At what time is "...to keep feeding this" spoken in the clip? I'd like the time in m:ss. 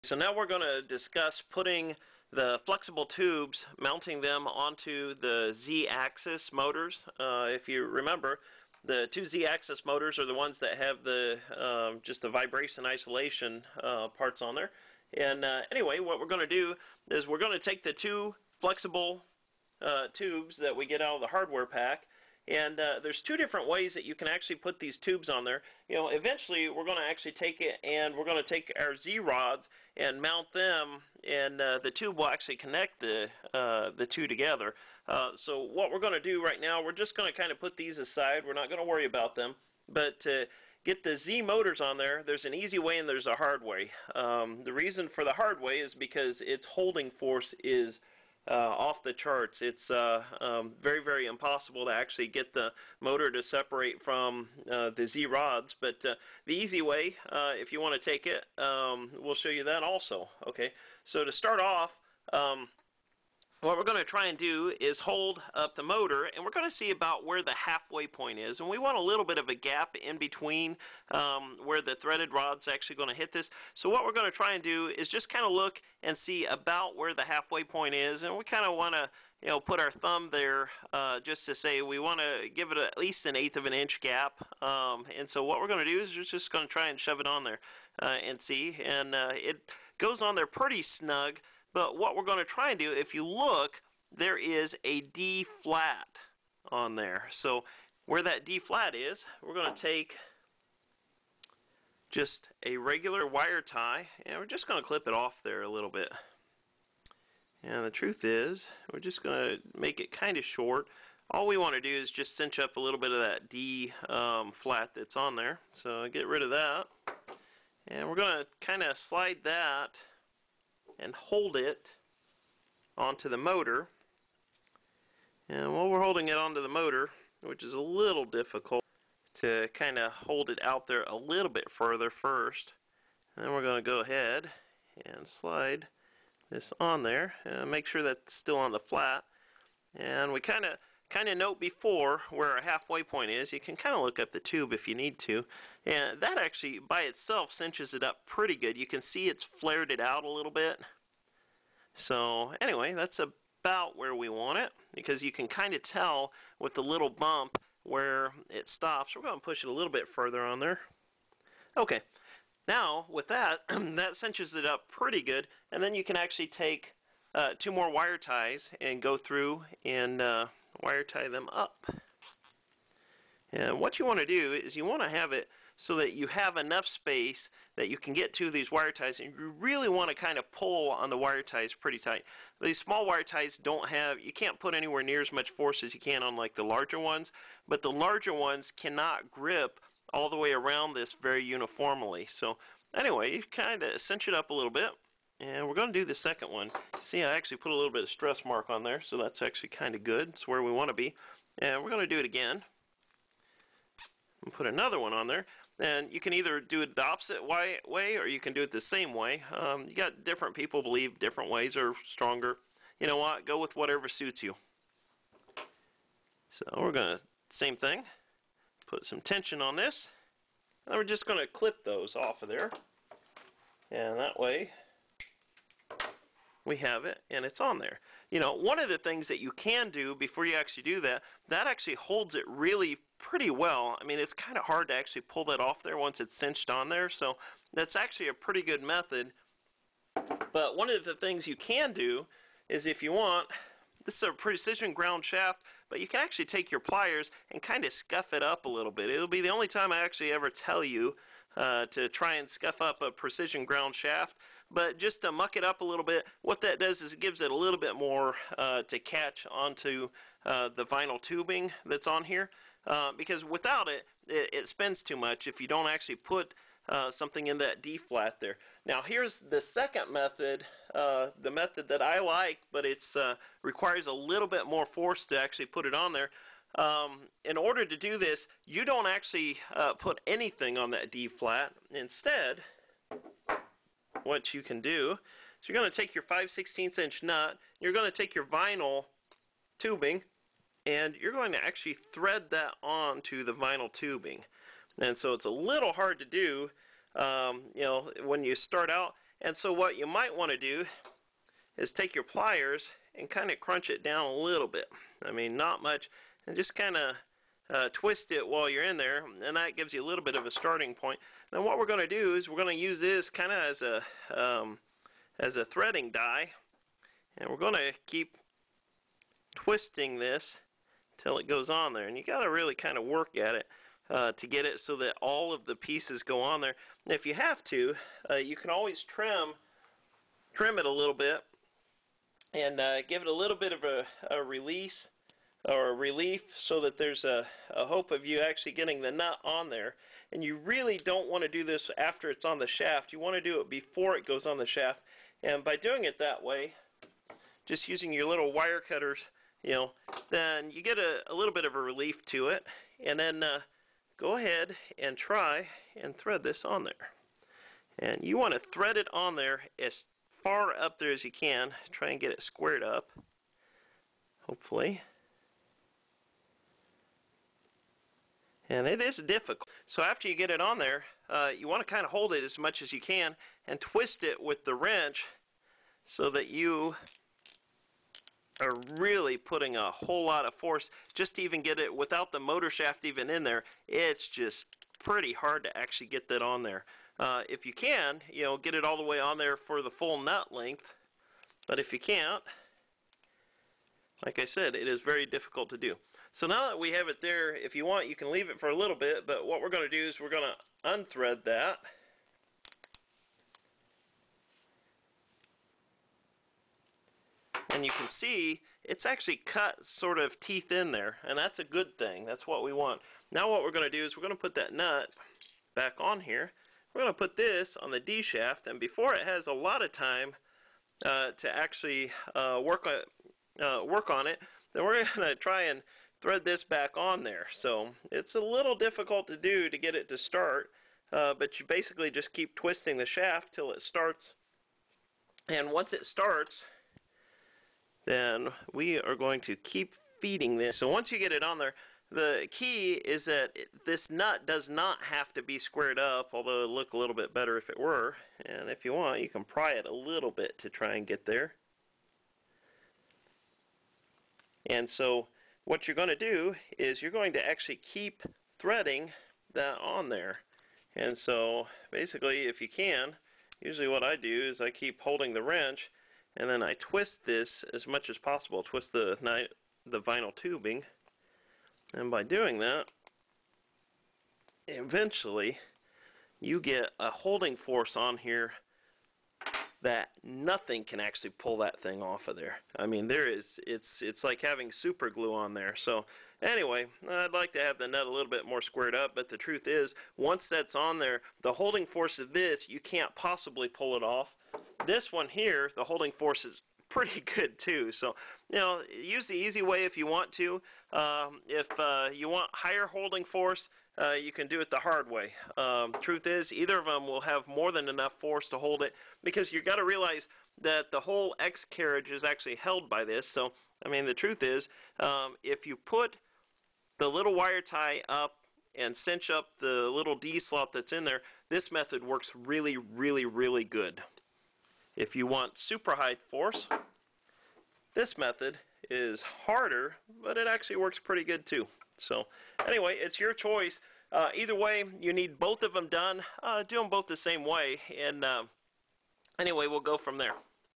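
7:19.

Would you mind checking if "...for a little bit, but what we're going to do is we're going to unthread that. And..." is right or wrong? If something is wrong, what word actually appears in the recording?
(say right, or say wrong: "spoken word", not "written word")
right.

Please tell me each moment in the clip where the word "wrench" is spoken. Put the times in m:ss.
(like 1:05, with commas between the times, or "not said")
6:14, 7:45.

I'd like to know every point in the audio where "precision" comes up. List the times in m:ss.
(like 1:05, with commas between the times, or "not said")
4:04, 4:13.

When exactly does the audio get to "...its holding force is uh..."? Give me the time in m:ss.
0:46.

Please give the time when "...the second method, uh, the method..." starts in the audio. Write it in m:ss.
4:29.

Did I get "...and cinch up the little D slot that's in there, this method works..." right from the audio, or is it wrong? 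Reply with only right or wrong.
right.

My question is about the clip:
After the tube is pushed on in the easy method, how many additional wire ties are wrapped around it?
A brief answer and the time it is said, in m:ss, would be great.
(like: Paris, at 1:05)
2, at 2:47.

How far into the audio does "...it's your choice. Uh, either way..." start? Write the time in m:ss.
8:52.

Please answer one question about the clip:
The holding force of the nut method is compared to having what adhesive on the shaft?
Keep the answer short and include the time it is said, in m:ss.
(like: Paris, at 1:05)
super glue, at 8:04.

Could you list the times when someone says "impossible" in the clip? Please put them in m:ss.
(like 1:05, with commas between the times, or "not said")
0:51.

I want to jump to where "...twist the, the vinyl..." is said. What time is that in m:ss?
7:48.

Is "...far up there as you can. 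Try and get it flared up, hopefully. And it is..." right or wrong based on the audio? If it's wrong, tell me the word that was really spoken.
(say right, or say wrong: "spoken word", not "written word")
wrong: "squared", not "flared".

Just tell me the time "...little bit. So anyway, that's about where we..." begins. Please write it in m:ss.
2:30.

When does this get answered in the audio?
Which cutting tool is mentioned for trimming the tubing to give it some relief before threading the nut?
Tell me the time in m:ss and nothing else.
5:48.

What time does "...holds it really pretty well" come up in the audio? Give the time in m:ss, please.
3:51.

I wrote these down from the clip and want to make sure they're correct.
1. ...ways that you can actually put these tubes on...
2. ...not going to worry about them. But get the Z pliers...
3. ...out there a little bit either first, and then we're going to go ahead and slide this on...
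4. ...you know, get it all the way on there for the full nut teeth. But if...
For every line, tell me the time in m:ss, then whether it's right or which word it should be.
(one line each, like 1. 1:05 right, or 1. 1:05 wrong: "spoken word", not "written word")
1. 0:23 right
2. 0:38 wrong: "motors", not "pliers"
3. 2:10 wrong: "further", not "either"
4. 6:28 wrong: "length", not "teeth".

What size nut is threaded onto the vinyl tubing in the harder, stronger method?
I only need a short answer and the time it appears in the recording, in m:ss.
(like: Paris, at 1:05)
5/16 inch, at 4:46.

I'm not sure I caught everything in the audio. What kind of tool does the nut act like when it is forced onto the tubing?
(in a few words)
threading die.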